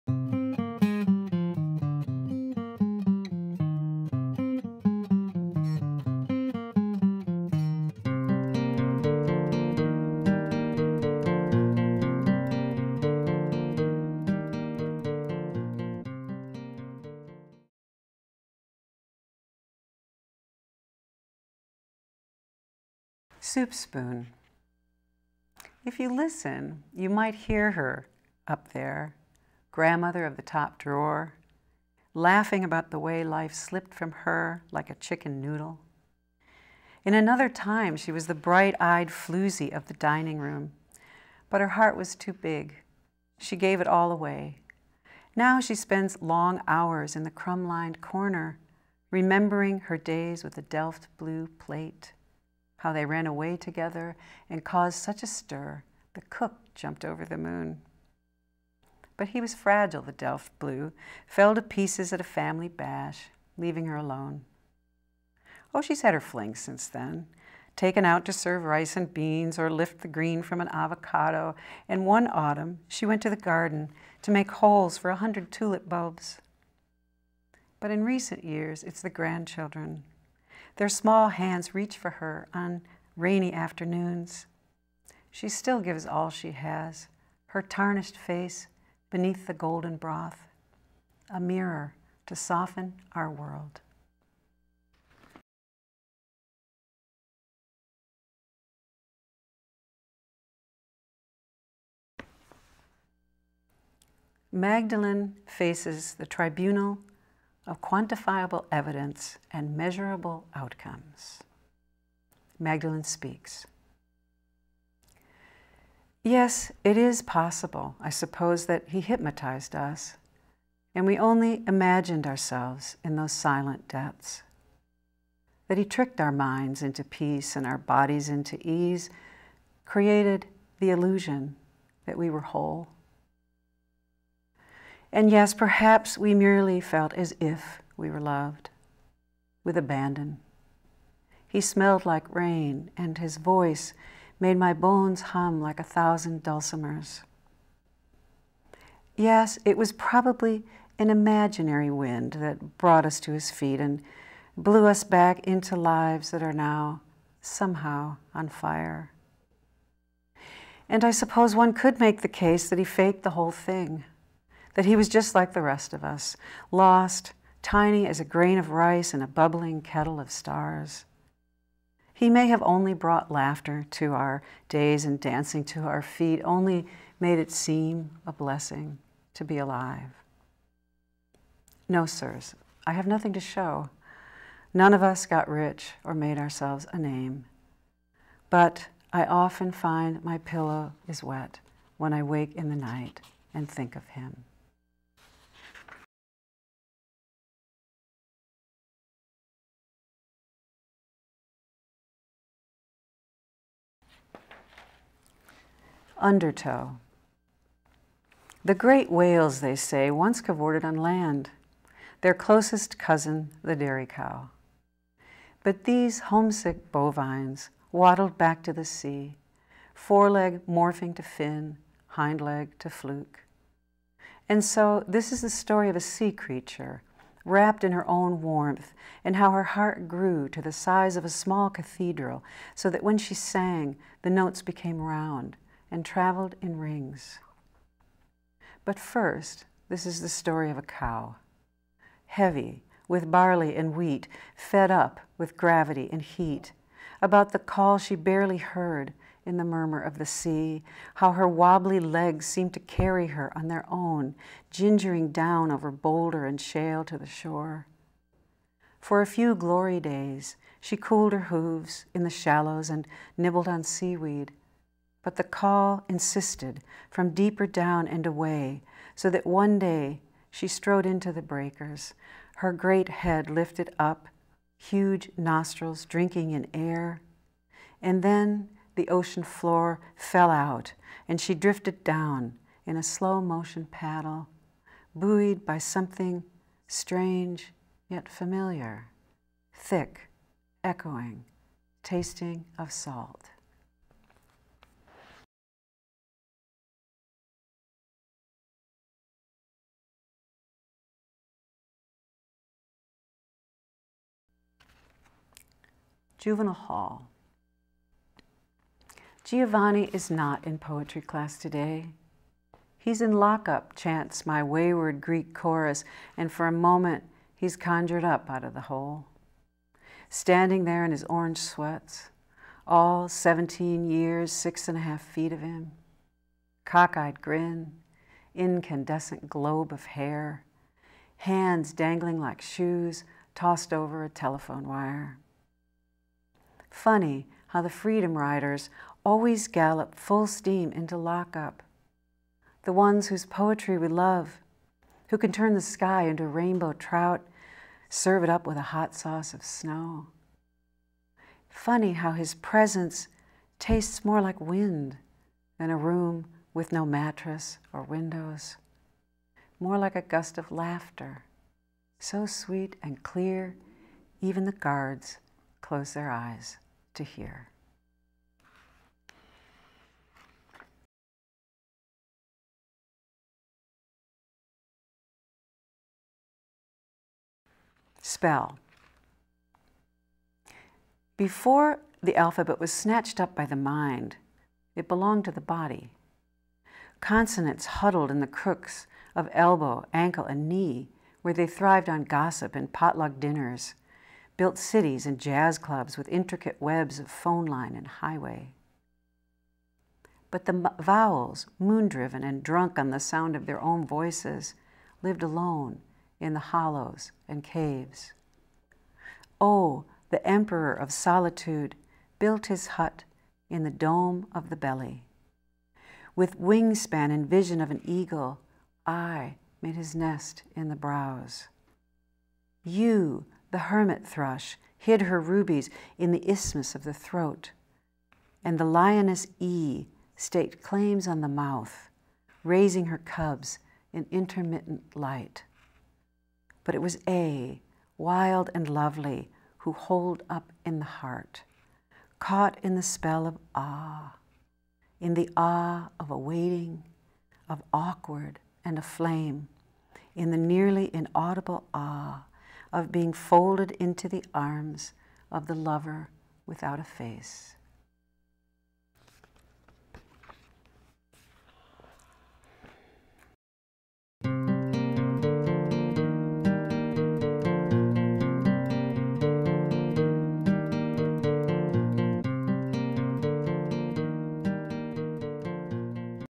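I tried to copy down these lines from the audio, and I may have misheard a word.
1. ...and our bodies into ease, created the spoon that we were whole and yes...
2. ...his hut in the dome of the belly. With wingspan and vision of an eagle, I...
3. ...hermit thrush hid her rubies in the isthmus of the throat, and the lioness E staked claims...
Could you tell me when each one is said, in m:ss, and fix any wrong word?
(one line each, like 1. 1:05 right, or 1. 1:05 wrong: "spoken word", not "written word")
1. 2:07 wrong: "illusion", not "spoon"
2. 6:52 right
3. 7:03 right.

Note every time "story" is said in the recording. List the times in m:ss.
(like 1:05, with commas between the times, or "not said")
3:45, 4:00.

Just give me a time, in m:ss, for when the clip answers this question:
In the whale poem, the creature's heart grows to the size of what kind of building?
3:51.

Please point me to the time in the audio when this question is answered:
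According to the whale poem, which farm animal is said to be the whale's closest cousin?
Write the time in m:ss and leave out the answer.
3:33.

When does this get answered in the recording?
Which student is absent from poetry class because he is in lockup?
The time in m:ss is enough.
5:09.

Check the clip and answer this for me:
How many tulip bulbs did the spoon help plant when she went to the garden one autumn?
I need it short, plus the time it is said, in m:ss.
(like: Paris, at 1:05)
100, at 1:15.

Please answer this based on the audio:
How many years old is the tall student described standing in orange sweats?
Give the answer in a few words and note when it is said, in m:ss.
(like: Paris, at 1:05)
17, at 5:23.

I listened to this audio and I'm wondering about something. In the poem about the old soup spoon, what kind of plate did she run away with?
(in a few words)
Delft blue plate.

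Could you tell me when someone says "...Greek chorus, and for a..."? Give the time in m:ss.
5:15.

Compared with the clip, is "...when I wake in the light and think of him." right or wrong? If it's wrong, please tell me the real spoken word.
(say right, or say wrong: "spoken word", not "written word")
wrong: "night", not "light".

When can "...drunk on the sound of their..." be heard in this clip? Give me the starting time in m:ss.
6:42.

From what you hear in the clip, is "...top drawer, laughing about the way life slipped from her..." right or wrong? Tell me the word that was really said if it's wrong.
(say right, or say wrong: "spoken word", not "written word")
right.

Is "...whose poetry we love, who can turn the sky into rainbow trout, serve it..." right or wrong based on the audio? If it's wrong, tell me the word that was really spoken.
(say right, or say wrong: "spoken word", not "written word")
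right.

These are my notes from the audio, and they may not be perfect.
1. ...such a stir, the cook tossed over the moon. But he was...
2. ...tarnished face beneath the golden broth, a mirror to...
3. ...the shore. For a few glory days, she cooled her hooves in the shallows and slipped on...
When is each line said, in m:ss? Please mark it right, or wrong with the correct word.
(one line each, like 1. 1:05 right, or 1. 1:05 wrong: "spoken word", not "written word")
1. 0:54 wrong: "jumped", not "tossed"
2. 1:27 right
3. 4:17 wrong: "nibbled", not "slipped".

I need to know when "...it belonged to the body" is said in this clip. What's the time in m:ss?
6:24.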